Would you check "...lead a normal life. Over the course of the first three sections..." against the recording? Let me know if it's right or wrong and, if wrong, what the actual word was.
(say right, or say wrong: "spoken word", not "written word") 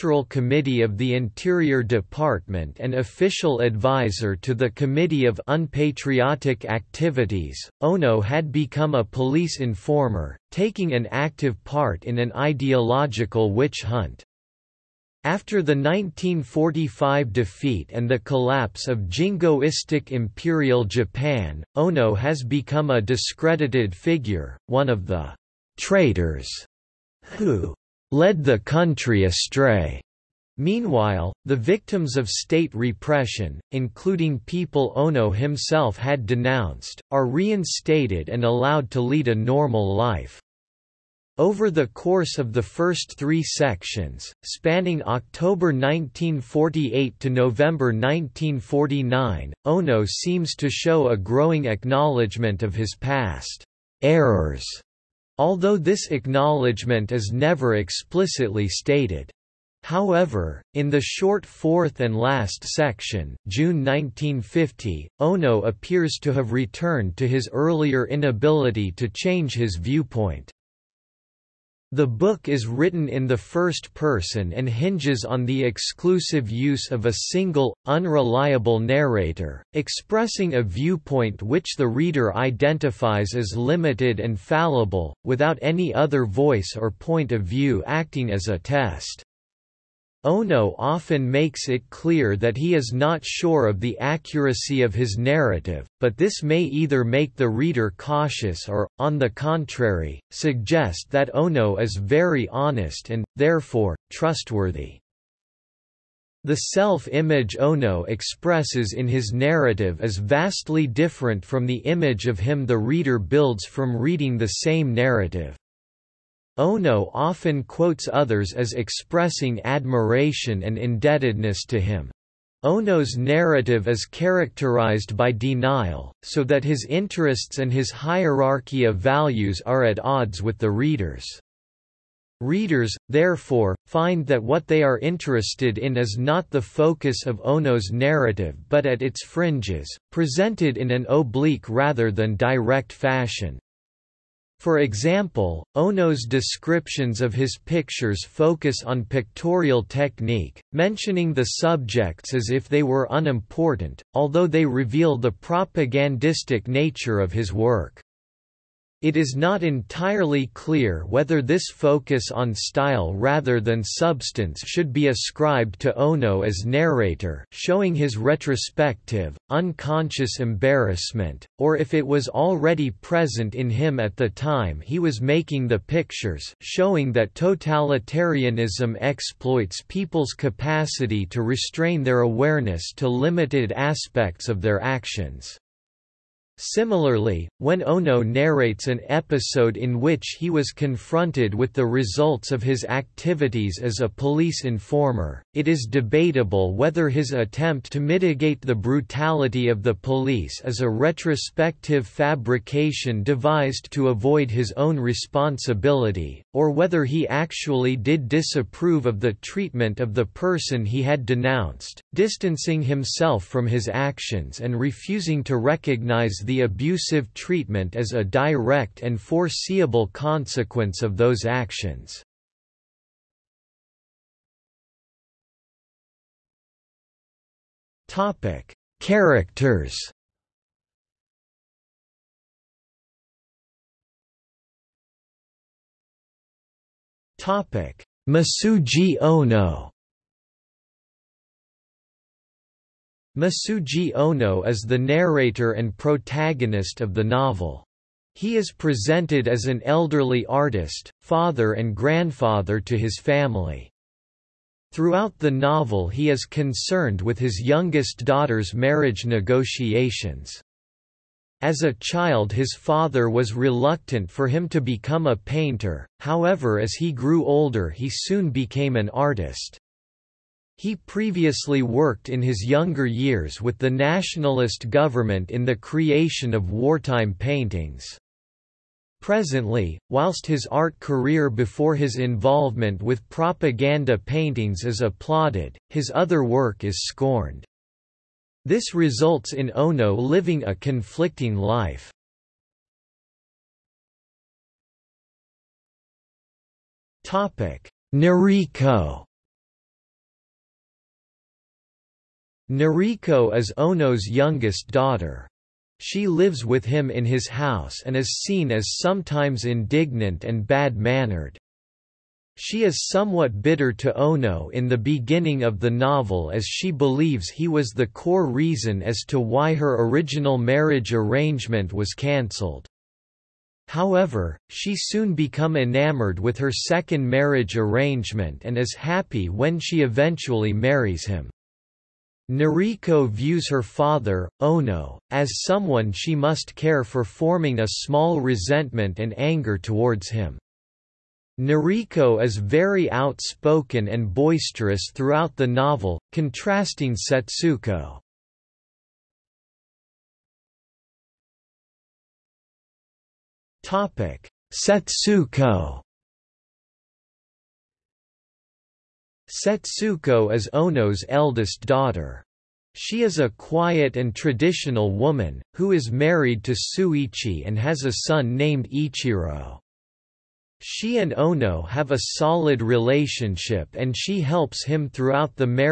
right.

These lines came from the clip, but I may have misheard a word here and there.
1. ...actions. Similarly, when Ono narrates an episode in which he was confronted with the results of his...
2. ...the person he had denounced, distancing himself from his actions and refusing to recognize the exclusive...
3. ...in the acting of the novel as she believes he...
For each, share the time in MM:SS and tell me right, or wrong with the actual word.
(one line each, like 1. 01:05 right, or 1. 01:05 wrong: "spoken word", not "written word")
1. 03:04 right
2. 03:30 wrong: "abusive", not "exclusive"
3. 05:14 wrong: "beginning", not "acting".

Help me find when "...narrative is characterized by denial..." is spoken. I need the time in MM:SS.
02:03.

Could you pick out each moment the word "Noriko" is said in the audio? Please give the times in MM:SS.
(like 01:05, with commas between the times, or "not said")
04:58, 05:02, 05:32, 05:41.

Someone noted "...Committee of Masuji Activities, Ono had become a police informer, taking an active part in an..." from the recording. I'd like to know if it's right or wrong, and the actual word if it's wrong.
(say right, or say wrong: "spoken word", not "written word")
wrong: "Unpatriotic", not "Masuji".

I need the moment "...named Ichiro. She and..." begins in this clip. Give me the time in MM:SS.
06:08.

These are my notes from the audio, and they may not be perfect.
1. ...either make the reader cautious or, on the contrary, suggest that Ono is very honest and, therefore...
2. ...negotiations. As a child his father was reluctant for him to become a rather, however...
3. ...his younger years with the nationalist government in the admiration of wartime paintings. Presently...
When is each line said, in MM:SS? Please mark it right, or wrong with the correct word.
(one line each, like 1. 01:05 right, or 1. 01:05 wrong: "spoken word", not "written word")
1. 01:36 right
2. 04:19 wrong: "painter", not "rather"
3. 04:32 wrong: "creation", not "admiration".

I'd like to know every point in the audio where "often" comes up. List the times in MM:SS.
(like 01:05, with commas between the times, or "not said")
01:30, 01:57.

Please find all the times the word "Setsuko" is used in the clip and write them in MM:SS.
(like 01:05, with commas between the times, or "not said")
05:47, 05:54, 05:59.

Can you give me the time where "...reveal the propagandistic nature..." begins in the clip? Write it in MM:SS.
02:34.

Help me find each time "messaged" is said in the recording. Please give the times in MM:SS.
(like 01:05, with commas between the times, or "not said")
not said.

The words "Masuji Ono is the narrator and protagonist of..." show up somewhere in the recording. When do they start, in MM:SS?
04:03.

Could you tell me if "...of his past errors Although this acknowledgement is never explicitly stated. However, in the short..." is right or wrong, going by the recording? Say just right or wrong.
right.